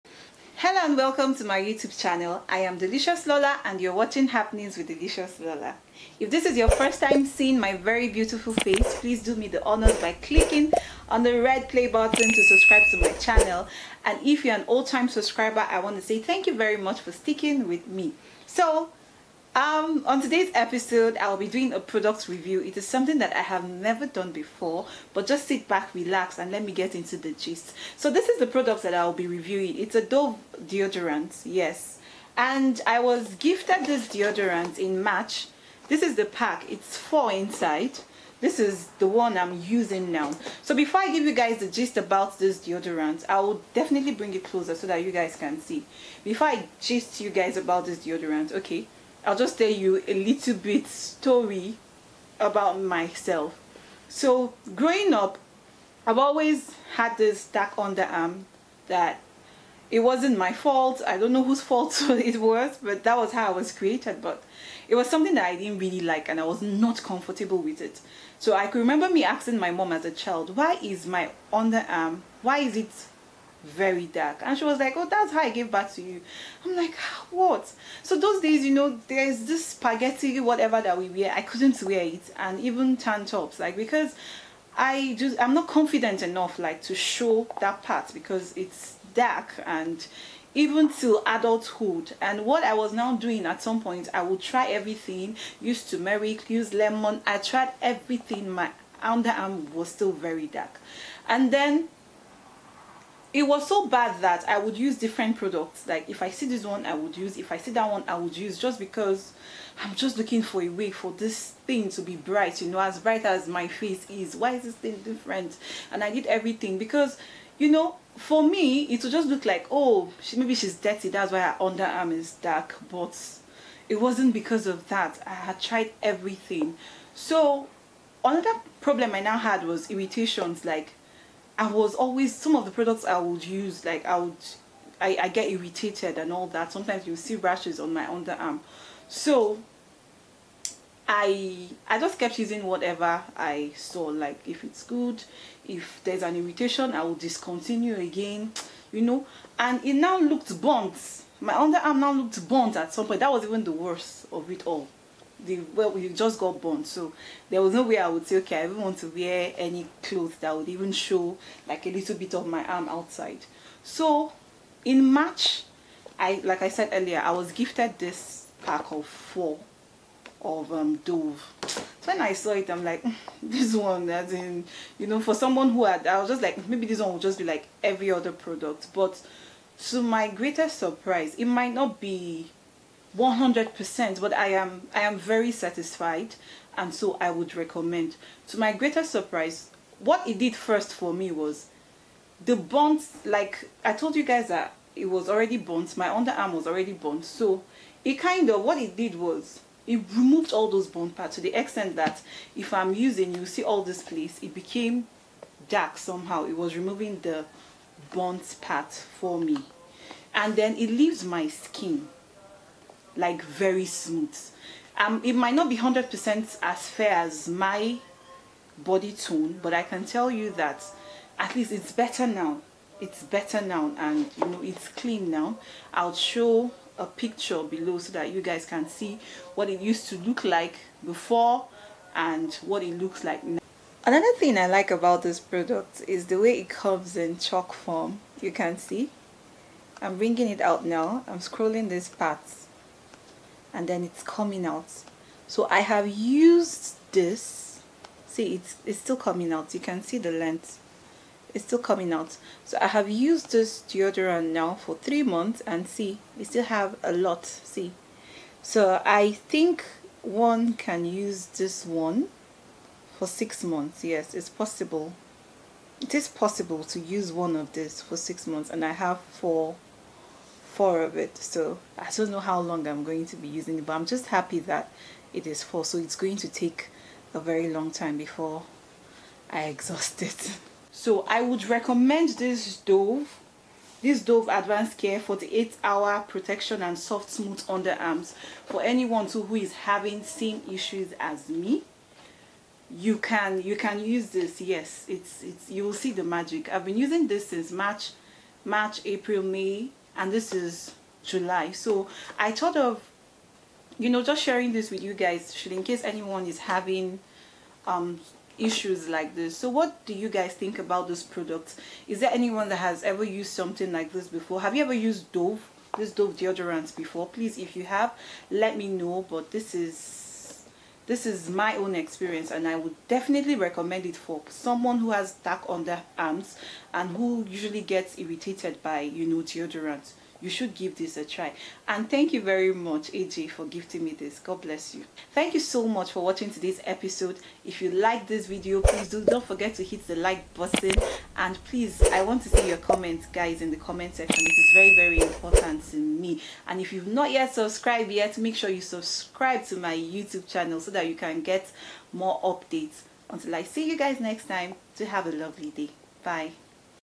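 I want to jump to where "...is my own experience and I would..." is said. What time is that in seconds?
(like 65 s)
321 s.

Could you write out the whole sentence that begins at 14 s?
And if you're an old-time subscriber, I want to say thank you very much for sticking with me.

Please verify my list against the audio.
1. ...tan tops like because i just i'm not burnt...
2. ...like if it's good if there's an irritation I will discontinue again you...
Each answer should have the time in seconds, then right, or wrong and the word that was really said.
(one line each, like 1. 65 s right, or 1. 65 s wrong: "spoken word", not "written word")
1. 82 s wrong: "confident", not "burnt"
2. 144 s right.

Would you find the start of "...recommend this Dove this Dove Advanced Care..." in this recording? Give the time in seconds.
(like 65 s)
281 s.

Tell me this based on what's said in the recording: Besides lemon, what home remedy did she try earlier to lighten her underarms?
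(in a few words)
Turmeric.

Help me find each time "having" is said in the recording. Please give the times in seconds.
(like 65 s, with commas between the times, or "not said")
289 s, 306 s.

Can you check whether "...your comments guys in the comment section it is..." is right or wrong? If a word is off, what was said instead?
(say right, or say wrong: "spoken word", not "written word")
right.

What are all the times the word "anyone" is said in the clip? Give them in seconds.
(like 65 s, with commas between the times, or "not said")
288 s, 306 s, 312 s.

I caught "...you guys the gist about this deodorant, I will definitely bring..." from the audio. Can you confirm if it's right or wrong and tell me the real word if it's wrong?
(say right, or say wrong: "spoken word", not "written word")
right.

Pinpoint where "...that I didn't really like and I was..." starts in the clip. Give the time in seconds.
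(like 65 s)
65 s.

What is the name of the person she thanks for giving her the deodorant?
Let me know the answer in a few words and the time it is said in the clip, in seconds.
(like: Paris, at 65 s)
AJ, at 333 s.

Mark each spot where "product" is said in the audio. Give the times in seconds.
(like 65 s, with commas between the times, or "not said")
21 s, 28 s, 105 s, 132 s, 178 s, 235 s, 311 s.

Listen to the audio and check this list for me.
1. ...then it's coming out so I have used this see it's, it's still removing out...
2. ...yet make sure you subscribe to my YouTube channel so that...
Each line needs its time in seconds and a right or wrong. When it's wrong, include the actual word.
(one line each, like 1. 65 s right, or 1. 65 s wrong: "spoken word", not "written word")
1. 243 s wrong: "coming", not "removing"
2. 348 s right.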